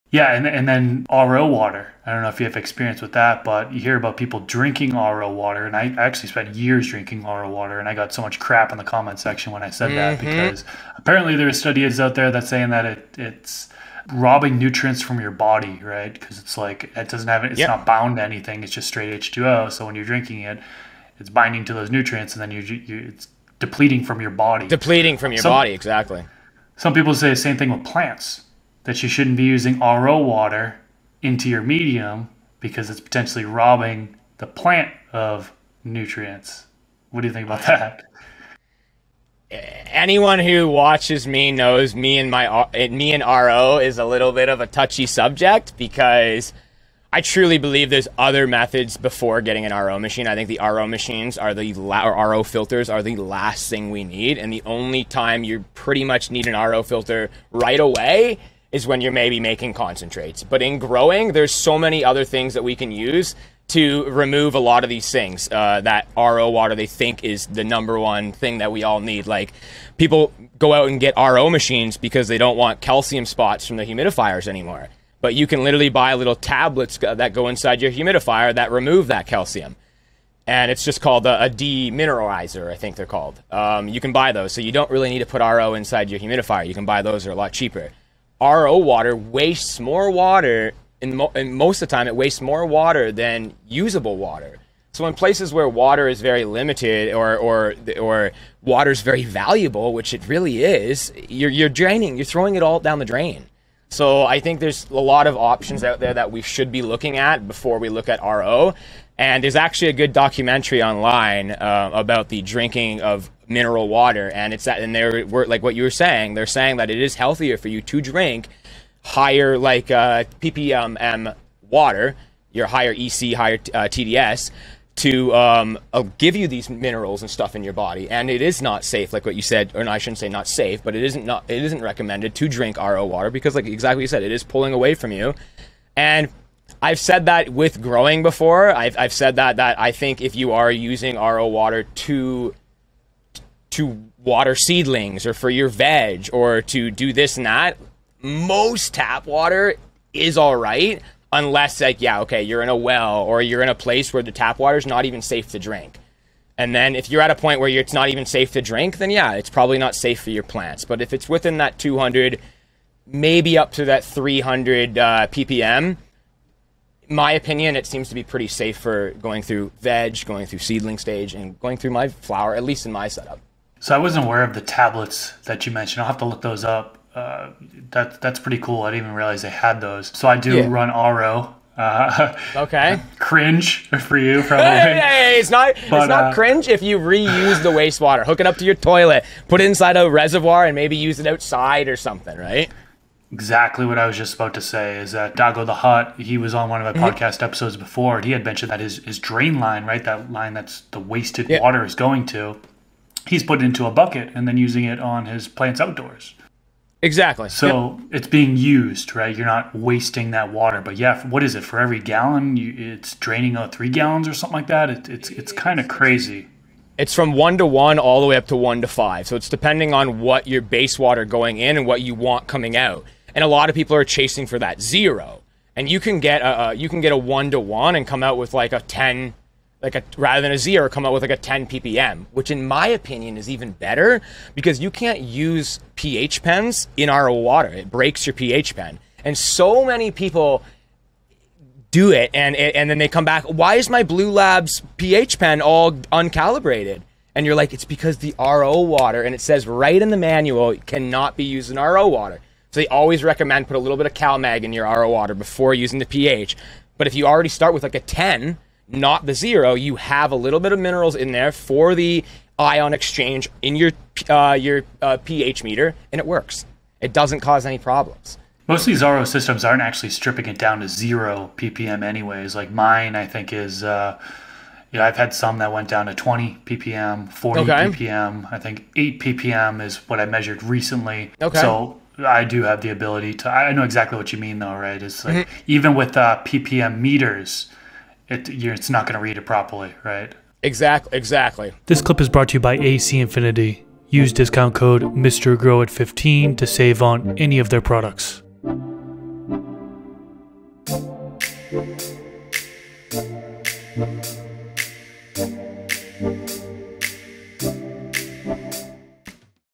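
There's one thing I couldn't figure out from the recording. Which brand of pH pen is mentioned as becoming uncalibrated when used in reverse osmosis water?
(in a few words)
Bluelab.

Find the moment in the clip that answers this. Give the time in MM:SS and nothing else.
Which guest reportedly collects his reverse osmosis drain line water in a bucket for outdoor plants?
03:15.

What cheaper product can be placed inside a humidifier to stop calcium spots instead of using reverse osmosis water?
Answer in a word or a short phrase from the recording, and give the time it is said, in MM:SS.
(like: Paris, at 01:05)
demineralizer, at 01:21.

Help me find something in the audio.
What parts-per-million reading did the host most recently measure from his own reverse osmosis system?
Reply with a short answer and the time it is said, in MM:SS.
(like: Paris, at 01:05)
8 ppm, at 04:38.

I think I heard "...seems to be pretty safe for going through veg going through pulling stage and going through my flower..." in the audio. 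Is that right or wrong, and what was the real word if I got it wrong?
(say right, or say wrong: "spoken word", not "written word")
wrong: "seedling", not "pulling".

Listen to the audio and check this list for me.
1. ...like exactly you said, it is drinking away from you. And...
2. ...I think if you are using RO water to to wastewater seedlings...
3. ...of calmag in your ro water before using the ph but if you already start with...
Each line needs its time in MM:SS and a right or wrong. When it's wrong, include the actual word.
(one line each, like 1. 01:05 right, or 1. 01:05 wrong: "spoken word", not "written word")
1. 02:13 wrong: "pulling", not "drinking"
2. 02:19 wrong: "water", not "wastewater"
3. 04:14 right.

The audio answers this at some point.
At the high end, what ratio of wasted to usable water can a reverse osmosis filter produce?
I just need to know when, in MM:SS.
03:38.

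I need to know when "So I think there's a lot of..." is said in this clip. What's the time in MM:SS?
01:43.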